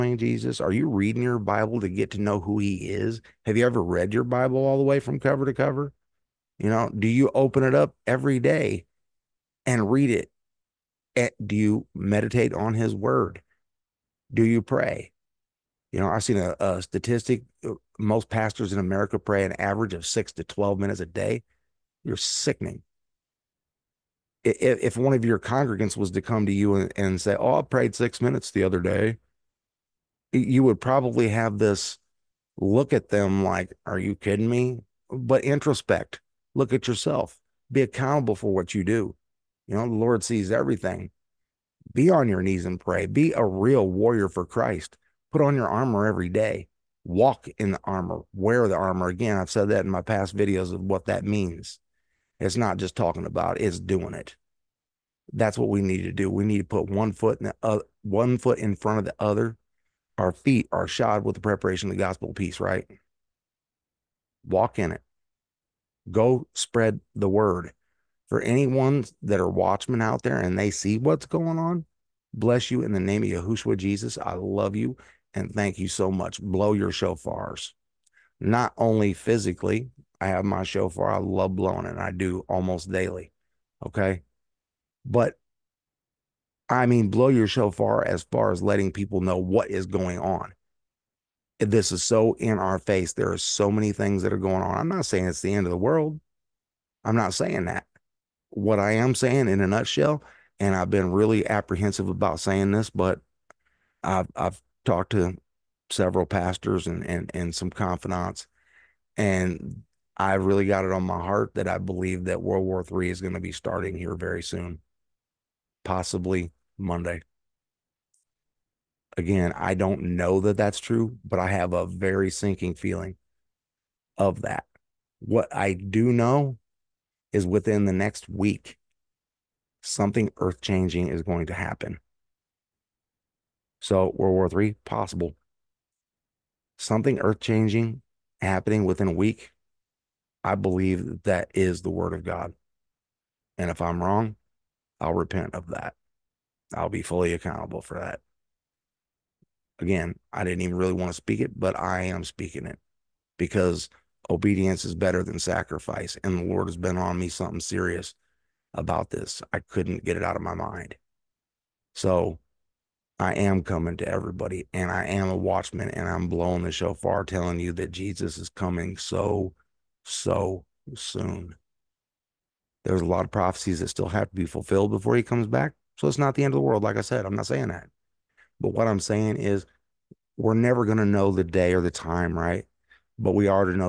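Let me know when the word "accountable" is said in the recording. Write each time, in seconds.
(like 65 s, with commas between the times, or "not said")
37 s, 147 s.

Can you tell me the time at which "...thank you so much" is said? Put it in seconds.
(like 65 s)
75 s.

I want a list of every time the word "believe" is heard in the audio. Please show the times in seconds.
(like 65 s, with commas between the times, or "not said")
111 s, 140 s.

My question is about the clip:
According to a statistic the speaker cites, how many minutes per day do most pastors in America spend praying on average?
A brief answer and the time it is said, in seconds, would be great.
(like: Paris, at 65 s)
6 to 12 minutes, at 20 s.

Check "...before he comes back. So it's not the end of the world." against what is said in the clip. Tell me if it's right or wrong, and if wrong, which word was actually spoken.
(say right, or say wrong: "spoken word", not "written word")
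right.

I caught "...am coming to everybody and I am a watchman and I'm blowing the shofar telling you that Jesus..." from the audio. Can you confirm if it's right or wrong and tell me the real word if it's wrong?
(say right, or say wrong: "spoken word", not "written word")
right.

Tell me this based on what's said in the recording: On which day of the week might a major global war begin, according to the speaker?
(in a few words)
Monday.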